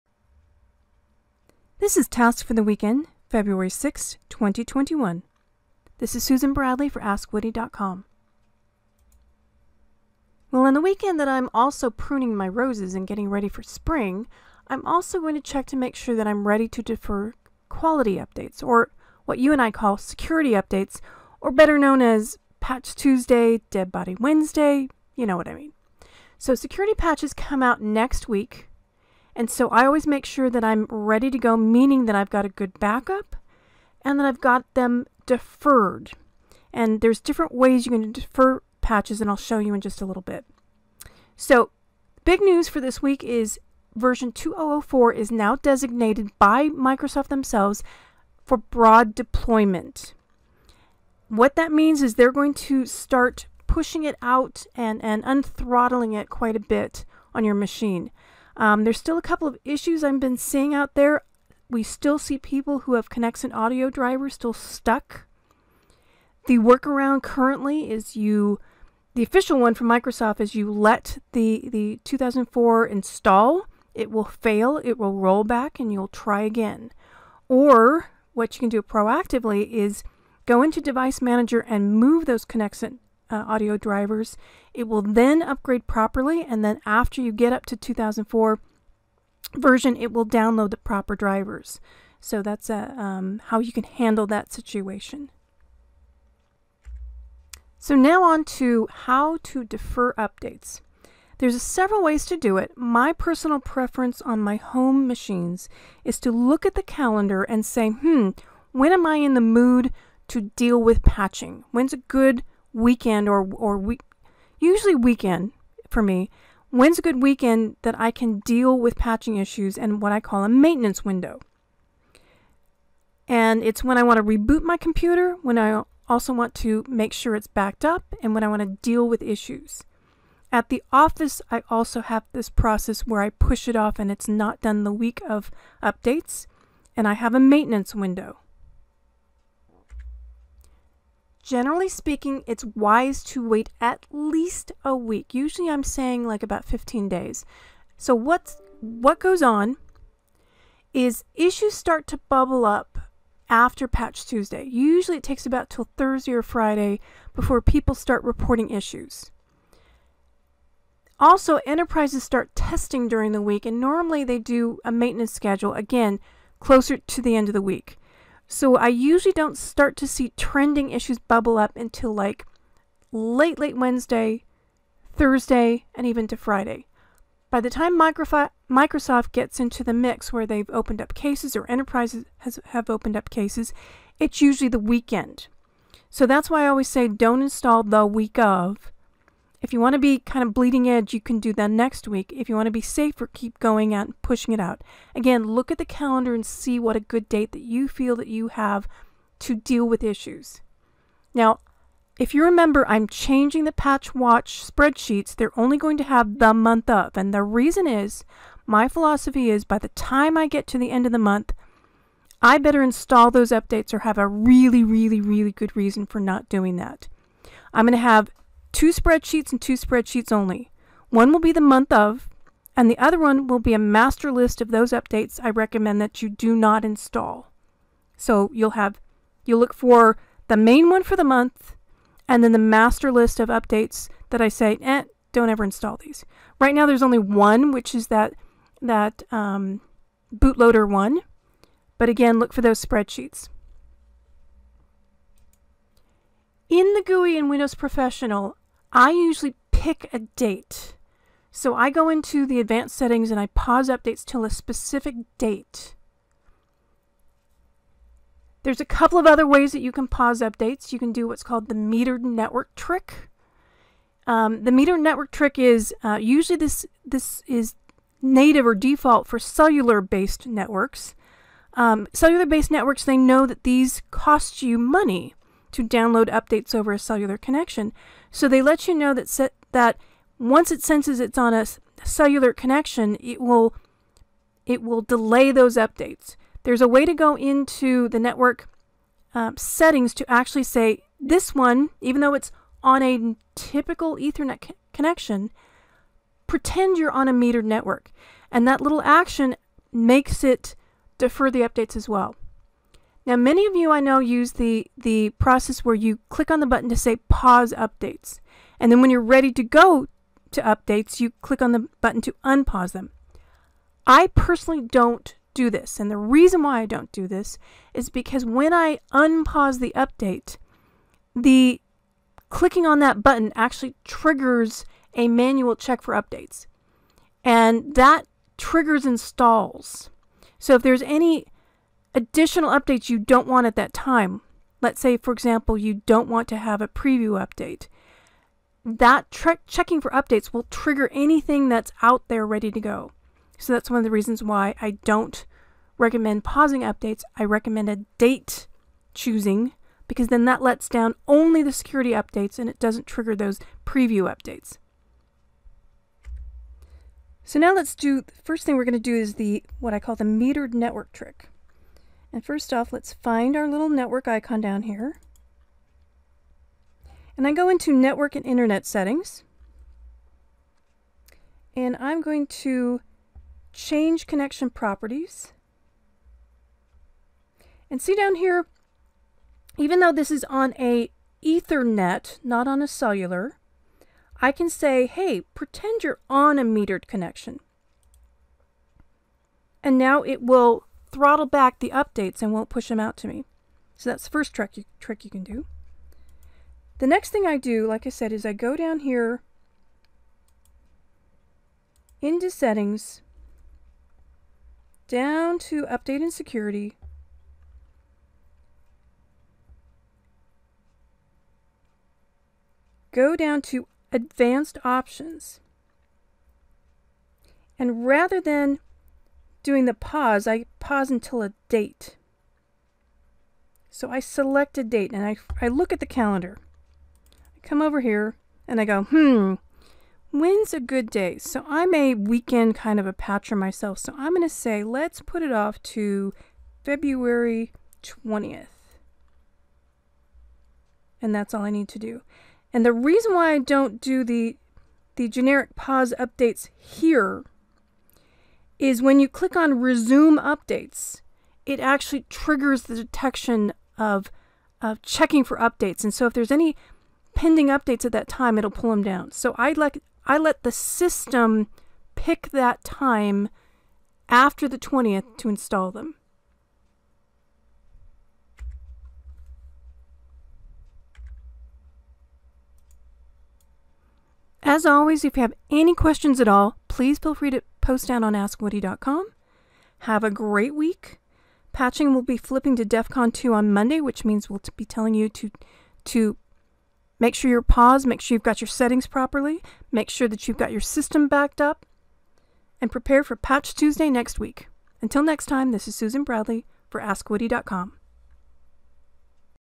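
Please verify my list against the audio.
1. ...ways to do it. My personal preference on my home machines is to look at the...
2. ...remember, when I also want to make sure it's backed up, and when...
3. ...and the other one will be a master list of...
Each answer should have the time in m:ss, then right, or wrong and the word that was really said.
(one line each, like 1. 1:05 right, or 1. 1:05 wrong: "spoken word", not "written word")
1. 1:42 right
2. 2:04 wrong: "computer", not "remember"
3. 3:42 right.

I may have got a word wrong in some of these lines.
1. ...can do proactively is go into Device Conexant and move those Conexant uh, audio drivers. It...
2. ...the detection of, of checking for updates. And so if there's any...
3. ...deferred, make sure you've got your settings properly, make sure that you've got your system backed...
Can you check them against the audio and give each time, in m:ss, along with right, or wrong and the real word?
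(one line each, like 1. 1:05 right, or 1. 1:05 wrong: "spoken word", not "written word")
1. 1:18 wrong: "Manager", not "Conexant"
2. 7:32 right
3. 8:07 wrong: "paused", not "deferred".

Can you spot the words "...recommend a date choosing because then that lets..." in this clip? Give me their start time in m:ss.
5:47.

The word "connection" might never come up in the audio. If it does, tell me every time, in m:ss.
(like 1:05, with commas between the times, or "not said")
4:37, 4:42, 4:54, 6:14, 6:27.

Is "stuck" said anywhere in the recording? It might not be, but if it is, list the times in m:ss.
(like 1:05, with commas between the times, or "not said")
1:04.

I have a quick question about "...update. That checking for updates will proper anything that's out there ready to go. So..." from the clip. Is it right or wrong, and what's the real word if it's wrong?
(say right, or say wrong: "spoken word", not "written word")
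wrong: "trigger", not "proper".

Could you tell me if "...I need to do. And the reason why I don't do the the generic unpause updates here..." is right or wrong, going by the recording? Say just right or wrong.
wrong.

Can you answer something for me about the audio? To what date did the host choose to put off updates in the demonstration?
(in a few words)
February 20.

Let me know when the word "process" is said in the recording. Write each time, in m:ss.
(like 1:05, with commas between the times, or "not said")
2:12, 5:05.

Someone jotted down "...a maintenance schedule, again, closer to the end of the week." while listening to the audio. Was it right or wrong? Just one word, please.
right.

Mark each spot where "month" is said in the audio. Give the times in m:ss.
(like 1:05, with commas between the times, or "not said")
3:26, 3:31, 3:41, 3:51.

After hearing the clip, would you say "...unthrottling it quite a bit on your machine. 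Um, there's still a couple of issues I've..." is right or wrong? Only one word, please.
right.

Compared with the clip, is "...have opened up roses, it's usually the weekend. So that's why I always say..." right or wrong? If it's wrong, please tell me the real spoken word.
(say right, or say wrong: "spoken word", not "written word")
wrong: "cases", not "roses".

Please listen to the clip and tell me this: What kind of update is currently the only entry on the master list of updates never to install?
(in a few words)
bootloader.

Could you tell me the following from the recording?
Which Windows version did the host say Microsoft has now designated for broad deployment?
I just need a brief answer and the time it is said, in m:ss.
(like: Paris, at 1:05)
2004, at 0:43.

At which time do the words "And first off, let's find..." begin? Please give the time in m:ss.
6:02.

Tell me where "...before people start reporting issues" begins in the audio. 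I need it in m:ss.
2:37.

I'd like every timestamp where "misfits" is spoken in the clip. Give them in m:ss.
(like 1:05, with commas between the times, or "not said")
not said.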